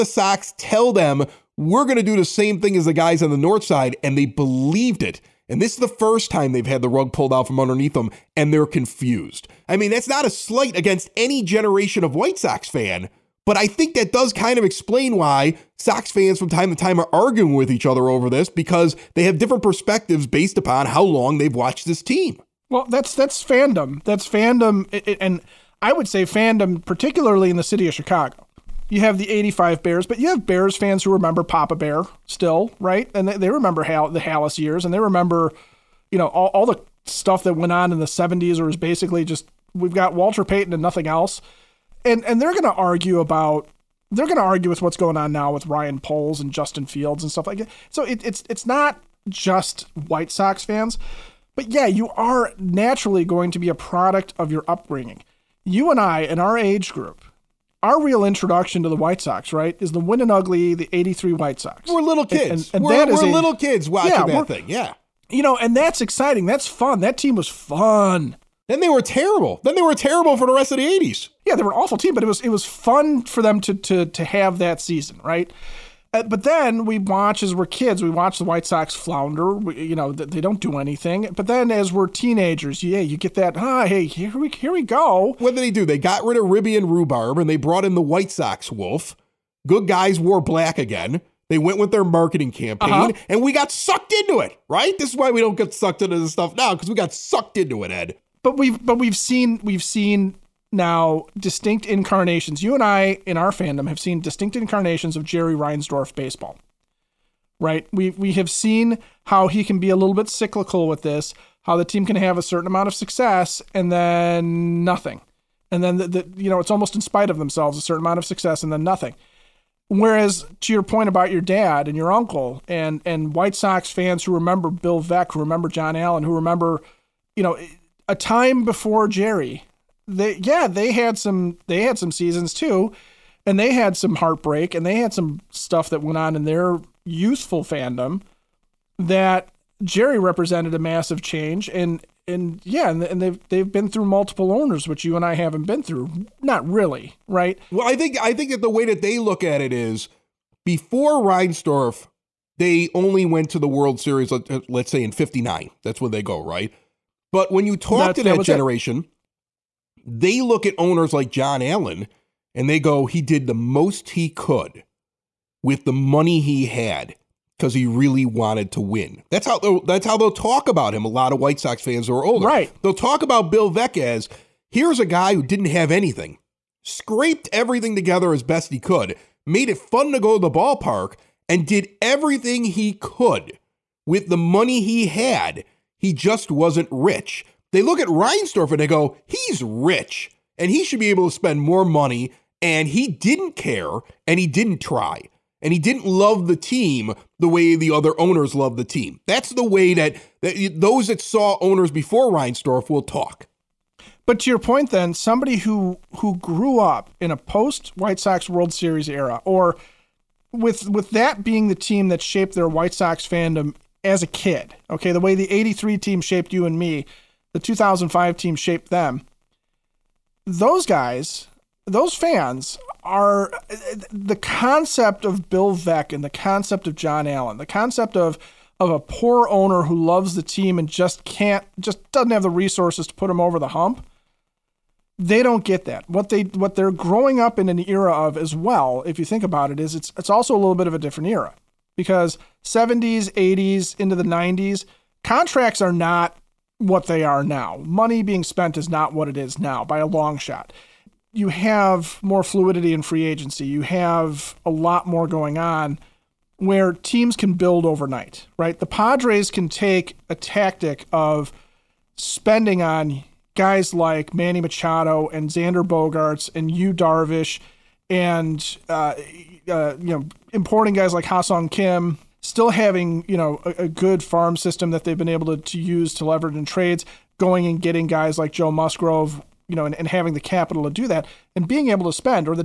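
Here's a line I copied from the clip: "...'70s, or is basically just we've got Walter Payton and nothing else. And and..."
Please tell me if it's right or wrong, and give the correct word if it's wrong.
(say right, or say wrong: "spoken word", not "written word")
right.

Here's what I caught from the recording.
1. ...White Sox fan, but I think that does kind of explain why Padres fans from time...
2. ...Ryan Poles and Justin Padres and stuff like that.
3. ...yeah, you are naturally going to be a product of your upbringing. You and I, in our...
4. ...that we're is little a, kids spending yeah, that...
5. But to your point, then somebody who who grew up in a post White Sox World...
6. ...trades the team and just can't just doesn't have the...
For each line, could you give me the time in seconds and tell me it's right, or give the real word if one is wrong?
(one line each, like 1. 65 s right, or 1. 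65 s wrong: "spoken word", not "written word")
1. 12 s wrong: "Sox", not "Padres"
2. 45 s wrong: "Fields", not "Padres"
3. 51 s right
4. 62 s wrong: "watching", not "spending"
5. 204 s right
6. 230 s wrong: "loves", not "trades".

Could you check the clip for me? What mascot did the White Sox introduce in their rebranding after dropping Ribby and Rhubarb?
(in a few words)
White Sox Wolf.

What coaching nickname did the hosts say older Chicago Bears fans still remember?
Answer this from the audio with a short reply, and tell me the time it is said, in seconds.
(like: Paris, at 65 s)
Papa Bear, at 31 s.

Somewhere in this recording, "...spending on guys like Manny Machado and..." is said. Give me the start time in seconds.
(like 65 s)
262 s.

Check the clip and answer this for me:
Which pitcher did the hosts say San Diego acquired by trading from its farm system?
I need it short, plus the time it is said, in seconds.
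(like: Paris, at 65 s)
Joe Musgrove, at 278 s.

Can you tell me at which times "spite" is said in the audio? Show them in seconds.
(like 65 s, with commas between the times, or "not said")
117 s.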